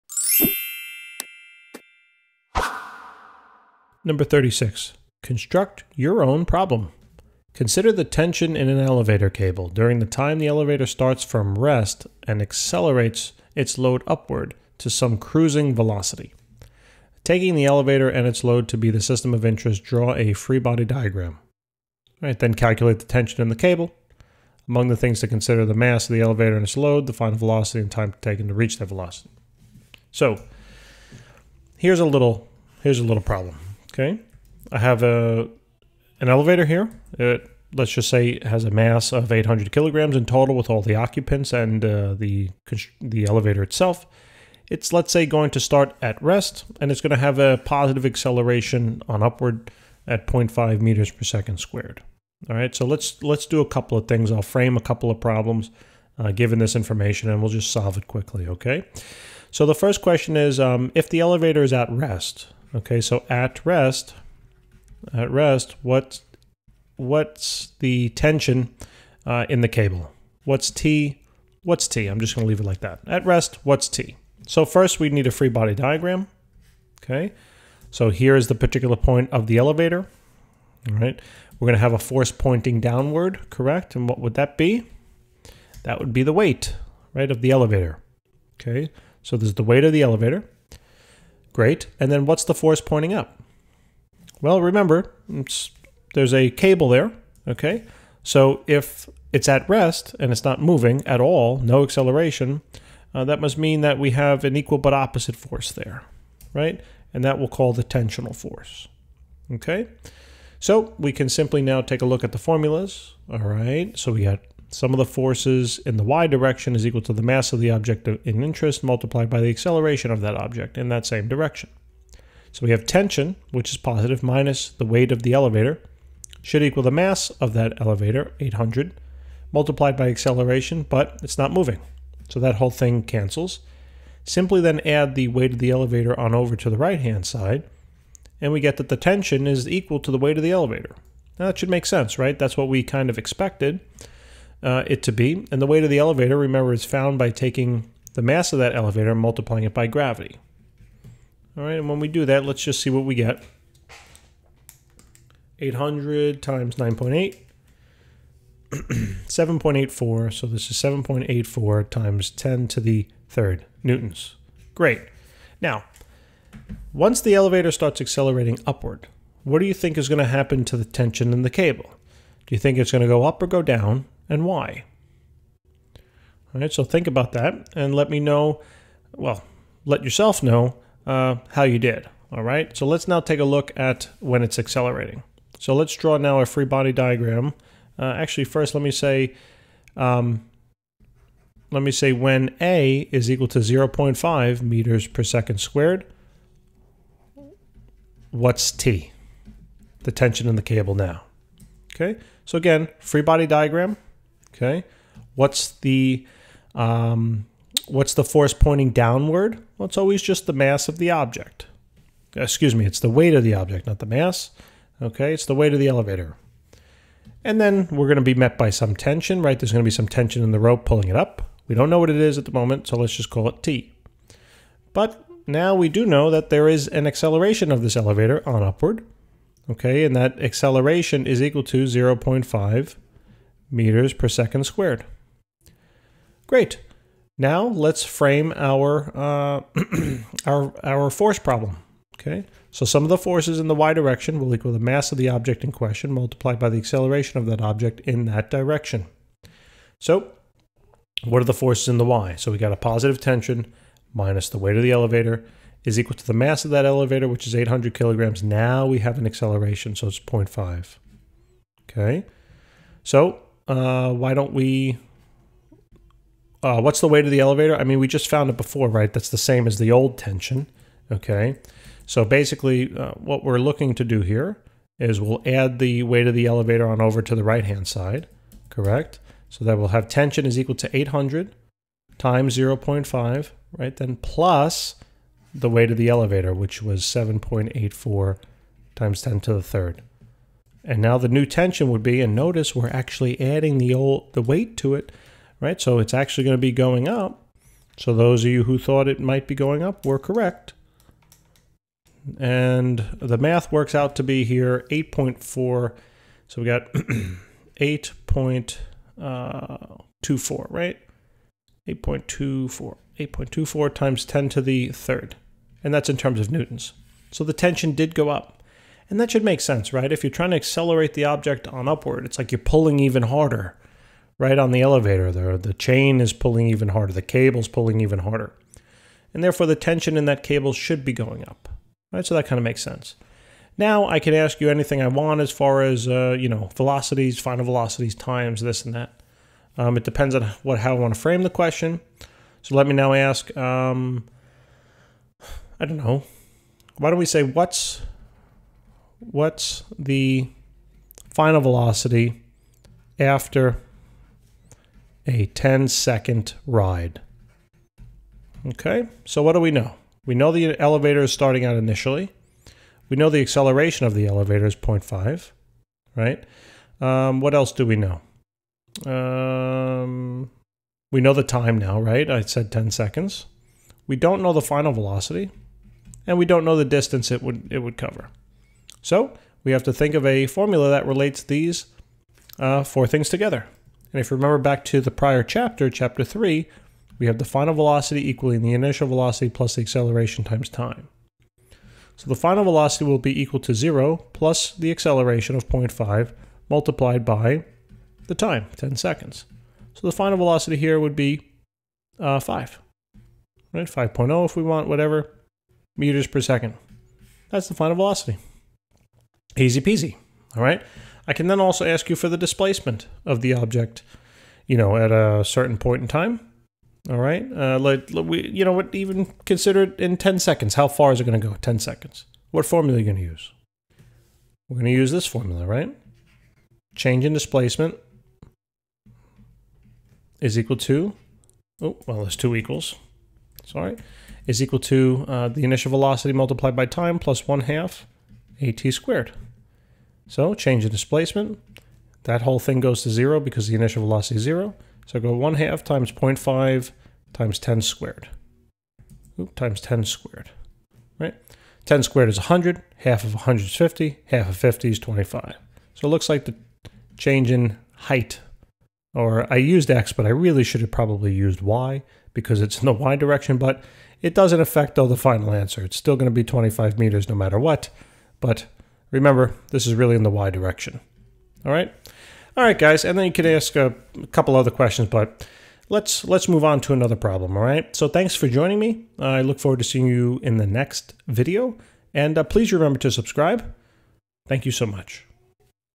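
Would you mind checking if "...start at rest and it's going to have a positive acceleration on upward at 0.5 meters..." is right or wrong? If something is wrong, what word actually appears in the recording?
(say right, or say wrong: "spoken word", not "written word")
right.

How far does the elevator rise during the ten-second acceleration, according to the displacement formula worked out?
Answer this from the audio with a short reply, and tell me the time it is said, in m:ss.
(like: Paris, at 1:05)
25 meters, at 7:46.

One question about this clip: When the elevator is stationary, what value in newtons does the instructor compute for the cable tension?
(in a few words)
7.84 times 10^3 newtons.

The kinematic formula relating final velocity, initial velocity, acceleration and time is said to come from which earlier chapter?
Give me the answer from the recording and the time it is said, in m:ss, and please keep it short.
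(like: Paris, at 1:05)
Chapter 3, at 6:25.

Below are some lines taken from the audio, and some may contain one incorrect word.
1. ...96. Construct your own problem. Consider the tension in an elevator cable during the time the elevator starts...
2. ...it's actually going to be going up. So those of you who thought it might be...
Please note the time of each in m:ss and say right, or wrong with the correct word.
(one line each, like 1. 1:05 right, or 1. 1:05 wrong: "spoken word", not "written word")
1. 0:04 wrong: "36", not "96"
2. 4:55 right.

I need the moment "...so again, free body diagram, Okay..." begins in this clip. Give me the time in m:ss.
3:22.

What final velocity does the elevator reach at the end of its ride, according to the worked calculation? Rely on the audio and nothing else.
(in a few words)
5.0 meters per second.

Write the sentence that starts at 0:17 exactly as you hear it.
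Taking the elevator and its load to be the system of interest, draw a free body diagram.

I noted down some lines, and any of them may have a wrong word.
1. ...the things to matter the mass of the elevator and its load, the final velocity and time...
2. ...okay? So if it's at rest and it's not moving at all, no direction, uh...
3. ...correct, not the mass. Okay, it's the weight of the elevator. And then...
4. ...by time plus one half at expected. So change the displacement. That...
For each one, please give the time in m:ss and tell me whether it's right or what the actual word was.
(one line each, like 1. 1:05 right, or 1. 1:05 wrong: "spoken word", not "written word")
1. 0:24 wrong: "consider", not "matter"
2. 1:37 wrong: "acceleration", not "direction"
3. 3:33 wrong: "object", not "correct"
4. 7:16 wrong: "squared", not "expected".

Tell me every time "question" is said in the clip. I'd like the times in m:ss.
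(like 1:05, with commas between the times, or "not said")
1:00, 4:05, 5:41, 7:54.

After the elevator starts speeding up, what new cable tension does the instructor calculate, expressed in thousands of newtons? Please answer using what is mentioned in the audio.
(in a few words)
8.24 times 10^3 newtons.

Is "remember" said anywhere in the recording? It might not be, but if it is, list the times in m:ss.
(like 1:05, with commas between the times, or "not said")
1:34, 2:26, 6:24, 7:49, 8:02.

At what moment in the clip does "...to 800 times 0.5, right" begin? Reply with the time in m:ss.
4:40.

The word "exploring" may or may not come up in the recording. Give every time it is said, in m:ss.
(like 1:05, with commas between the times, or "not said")
not said.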